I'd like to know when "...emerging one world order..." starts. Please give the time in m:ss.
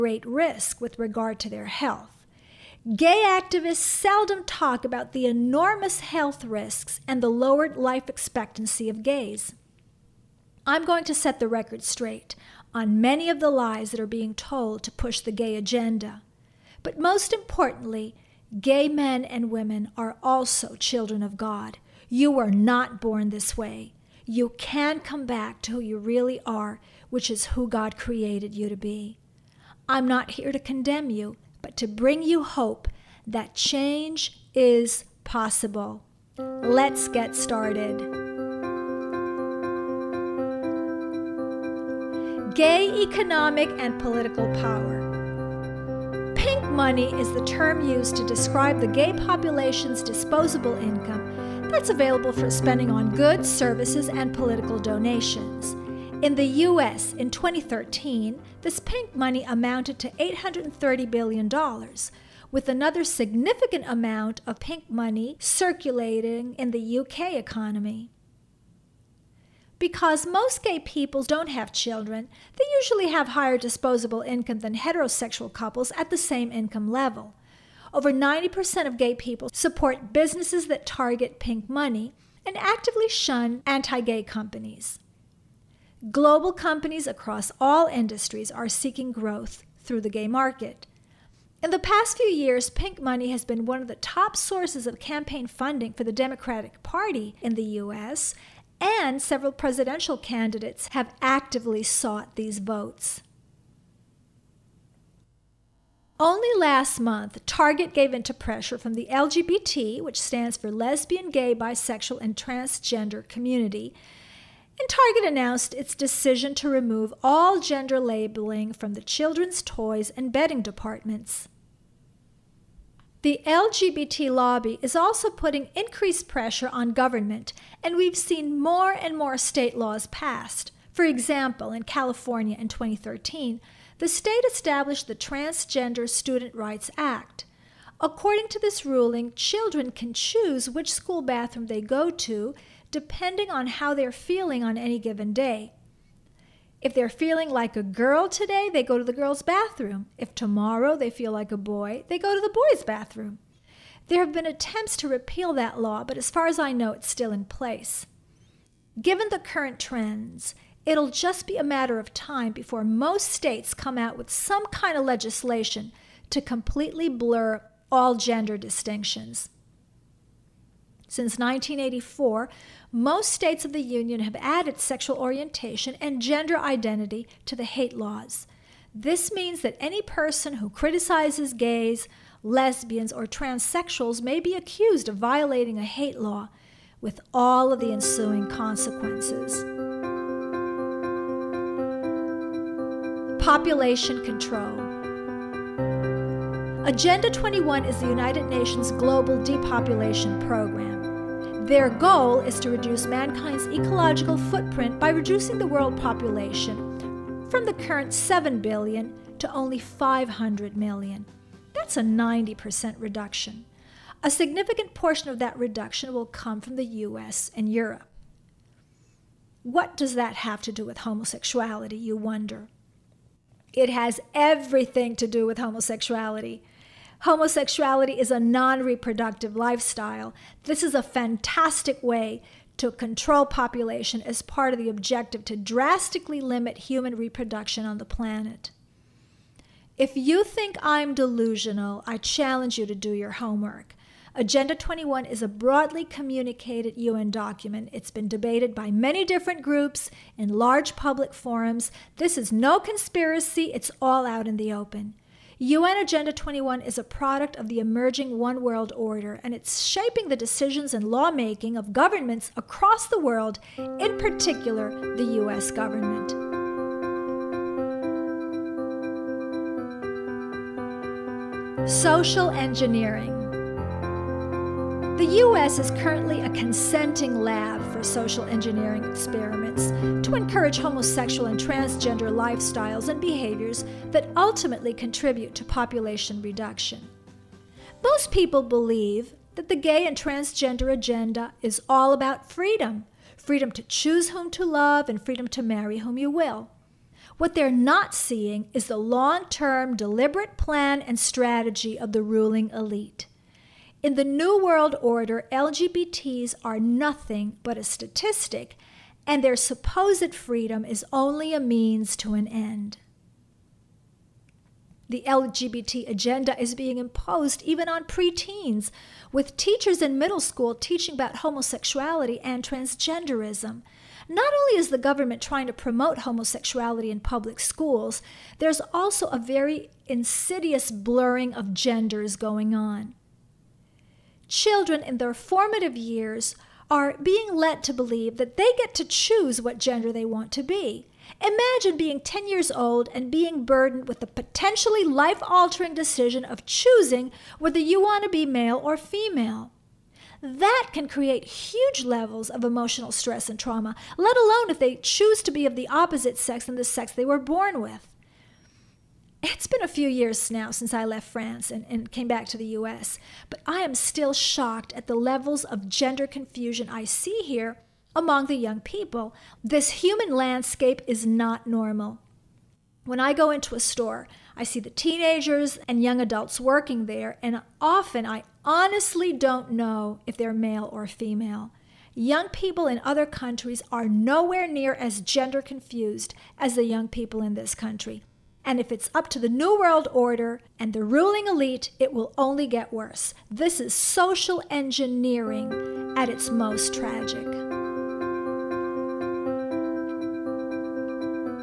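4:17.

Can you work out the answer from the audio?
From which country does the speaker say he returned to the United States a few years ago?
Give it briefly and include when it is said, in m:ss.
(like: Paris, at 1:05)
France, at 6:01.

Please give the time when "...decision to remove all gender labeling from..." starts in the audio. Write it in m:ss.
1:55.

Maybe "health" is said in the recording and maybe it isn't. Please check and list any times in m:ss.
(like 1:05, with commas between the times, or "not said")
0:01, 0:05.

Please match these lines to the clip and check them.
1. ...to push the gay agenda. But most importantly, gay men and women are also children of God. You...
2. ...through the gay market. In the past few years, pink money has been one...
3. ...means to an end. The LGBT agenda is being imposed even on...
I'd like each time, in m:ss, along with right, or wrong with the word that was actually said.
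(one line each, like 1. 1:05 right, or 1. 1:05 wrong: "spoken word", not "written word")
1. 0:14 right
2. 1:29 right
3. 5:11 right.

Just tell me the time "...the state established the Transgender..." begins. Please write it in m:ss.
2:13.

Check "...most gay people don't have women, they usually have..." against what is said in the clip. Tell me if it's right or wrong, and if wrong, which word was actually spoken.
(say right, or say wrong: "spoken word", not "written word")
wrong: "children", not "women".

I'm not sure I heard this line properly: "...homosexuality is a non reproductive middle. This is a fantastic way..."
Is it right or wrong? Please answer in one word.
wrong.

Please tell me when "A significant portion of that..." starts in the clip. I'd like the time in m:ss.
3:34.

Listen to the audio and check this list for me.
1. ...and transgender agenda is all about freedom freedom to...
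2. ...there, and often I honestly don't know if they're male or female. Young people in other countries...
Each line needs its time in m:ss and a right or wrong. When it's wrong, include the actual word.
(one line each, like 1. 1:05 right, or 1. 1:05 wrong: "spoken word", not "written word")
1. 4:50 right
2. 6:17 right.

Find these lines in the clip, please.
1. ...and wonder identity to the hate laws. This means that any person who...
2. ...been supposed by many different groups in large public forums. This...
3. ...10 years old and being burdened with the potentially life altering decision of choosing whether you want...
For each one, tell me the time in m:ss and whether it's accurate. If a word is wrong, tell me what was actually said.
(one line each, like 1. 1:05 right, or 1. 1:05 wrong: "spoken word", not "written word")
1. 2:55 wrong: "gender", not "wonder"
2. 4:08 wrong: "debated", not "supposed"
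3. 5:42 right.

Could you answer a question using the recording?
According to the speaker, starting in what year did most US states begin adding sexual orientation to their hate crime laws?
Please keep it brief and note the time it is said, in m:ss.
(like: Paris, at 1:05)
1984, at 2:51.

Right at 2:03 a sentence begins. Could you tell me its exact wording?
The LGBT lobby is also putting increased pressure on government, and we've seen more and more state laws passed.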